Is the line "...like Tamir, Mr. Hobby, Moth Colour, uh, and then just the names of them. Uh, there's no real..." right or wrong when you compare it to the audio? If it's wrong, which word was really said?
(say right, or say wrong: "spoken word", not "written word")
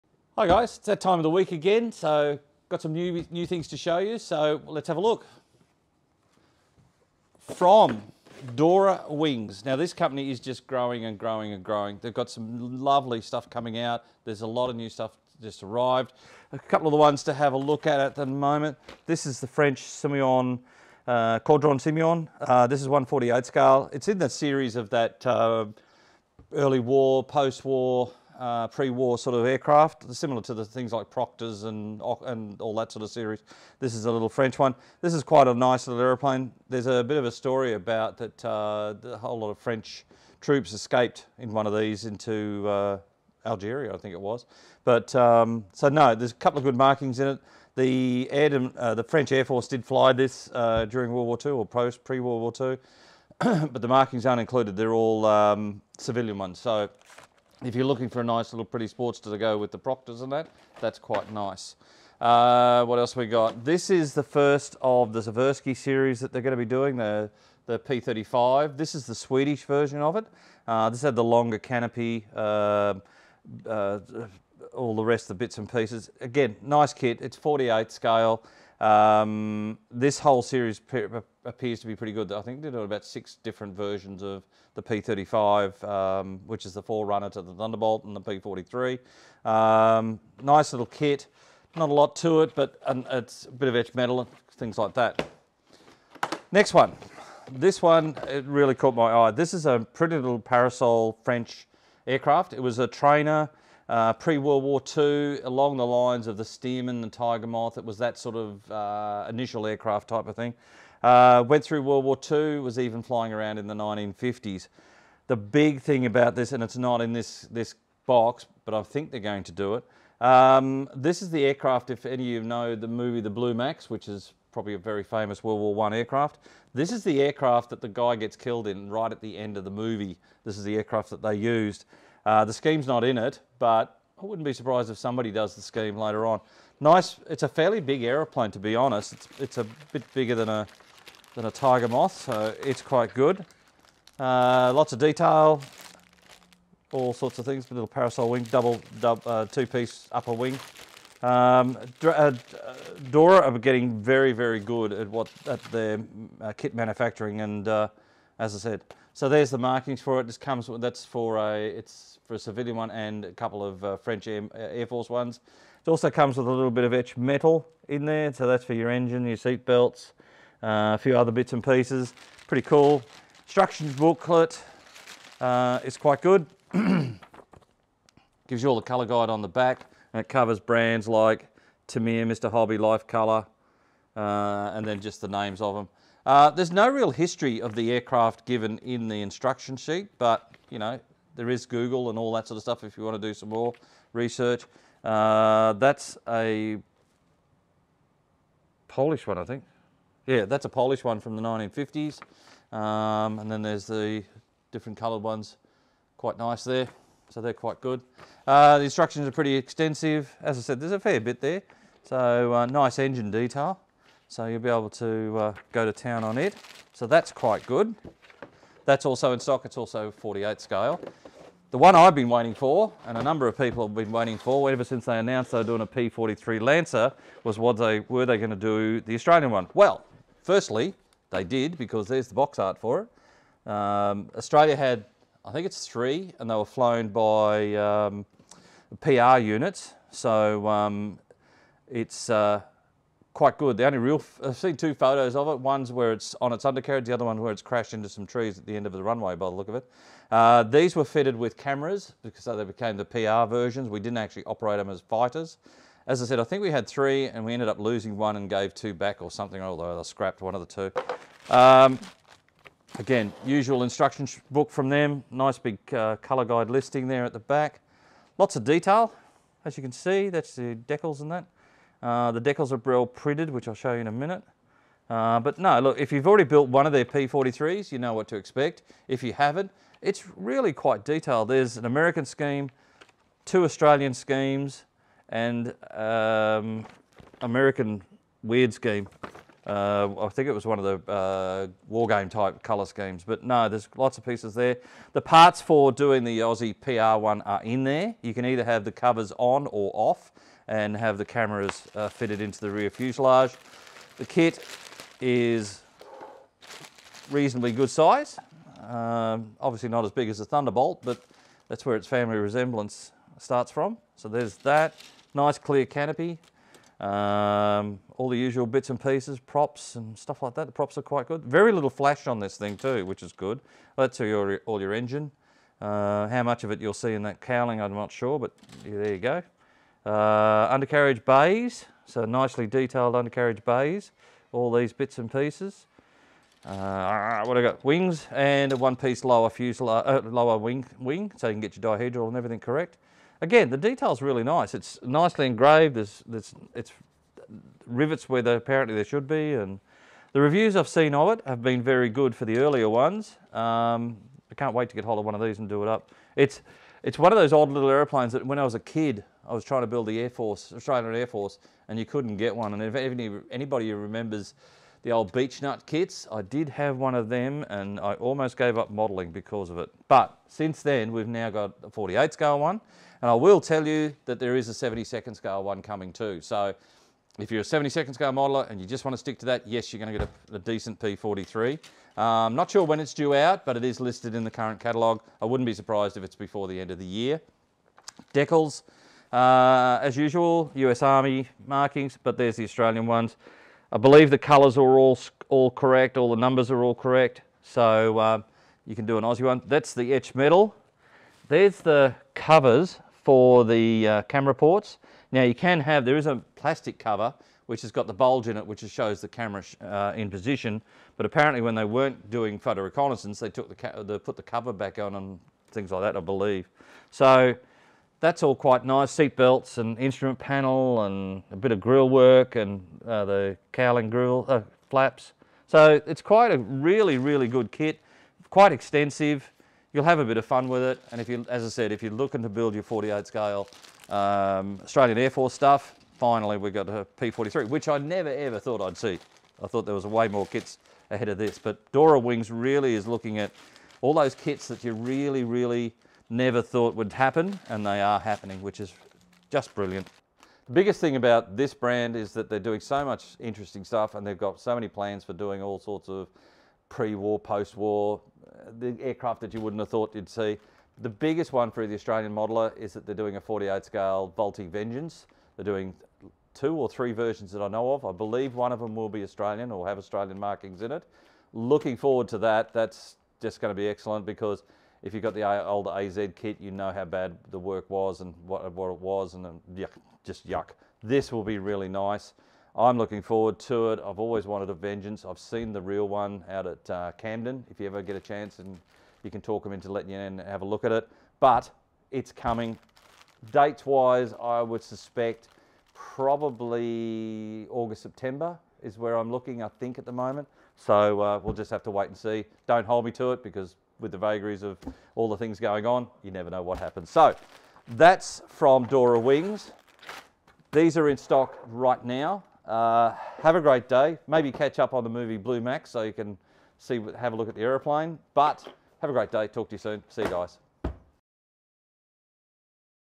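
wrong: "Life", not "Moth".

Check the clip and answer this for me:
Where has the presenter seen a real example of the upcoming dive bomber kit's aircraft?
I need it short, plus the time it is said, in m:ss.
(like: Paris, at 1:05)
Camden, at 8:07.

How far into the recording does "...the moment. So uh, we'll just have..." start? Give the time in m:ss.
8:20.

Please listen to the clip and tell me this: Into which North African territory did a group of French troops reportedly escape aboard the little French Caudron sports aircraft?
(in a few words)
Algeria.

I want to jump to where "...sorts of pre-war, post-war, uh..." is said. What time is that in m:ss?
7:35.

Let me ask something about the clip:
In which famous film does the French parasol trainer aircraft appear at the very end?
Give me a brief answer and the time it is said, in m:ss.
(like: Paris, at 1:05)
The Blue Max, at 2:03.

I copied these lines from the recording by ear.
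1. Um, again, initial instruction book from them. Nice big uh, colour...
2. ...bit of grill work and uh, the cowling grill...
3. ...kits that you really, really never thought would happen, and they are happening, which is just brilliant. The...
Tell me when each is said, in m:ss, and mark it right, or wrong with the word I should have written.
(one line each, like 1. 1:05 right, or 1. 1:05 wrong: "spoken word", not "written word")
1. 4:21 wrong: "usual", not "initial"
2. 7:01 right
3. 7:24 right.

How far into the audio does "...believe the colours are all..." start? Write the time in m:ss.
6:33.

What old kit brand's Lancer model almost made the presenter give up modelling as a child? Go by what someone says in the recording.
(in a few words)
Beech Nut.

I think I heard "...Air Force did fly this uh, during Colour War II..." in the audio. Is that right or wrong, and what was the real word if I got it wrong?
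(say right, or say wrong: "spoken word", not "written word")
wrong: "World", not "Colour".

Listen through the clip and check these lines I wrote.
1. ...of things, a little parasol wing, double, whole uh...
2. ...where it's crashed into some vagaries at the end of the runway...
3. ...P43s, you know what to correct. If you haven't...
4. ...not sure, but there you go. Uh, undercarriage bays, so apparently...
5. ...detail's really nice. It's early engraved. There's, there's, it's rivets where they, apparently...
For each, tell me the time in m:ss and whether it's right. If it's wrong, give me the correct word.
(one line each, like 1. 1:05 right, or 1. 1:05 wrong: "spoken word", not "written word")
1. 2:27 wrong: "double", not "whole"
2. 4:07 wrong: "trees", not "vagaries"
3. 4:37 wrong: "expect", not "correct"
4. 5:27 wrong: "nicely", not "apparently"
5. 5:43 wrong: "nicely", not "early".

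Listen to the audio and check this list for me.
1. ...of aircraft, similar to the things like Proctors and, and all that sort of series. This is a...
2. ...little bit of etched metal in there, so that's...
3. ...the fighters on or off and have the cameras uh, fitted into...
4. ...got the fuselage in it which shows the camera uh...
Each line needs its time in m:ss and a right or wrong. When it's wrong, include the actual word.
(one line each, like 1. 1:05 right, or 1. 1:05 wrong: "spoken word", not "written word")
1. 0:29 right
2. 2:46 right
3. 4:58 wrong: "covers", not "fighters"
4. 6:47 wrong: "bulge", not "fuselage".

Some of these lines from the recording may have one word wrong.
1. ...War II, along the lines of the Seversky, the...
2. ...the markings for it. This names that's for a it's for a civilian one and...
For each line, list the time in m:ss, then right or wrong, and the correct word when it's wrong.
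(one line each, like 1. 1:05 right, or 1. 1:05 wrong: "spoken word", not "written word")
1. 1:44 wrong: "Stearman", not "Seversky"
2. 2:39 wrong: "comes", not "names".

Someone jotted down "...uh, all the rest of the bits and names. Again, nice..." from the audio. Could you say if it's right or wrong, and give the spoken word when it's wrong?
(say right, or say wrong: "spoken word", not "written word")
wrong: "pieces", not "names".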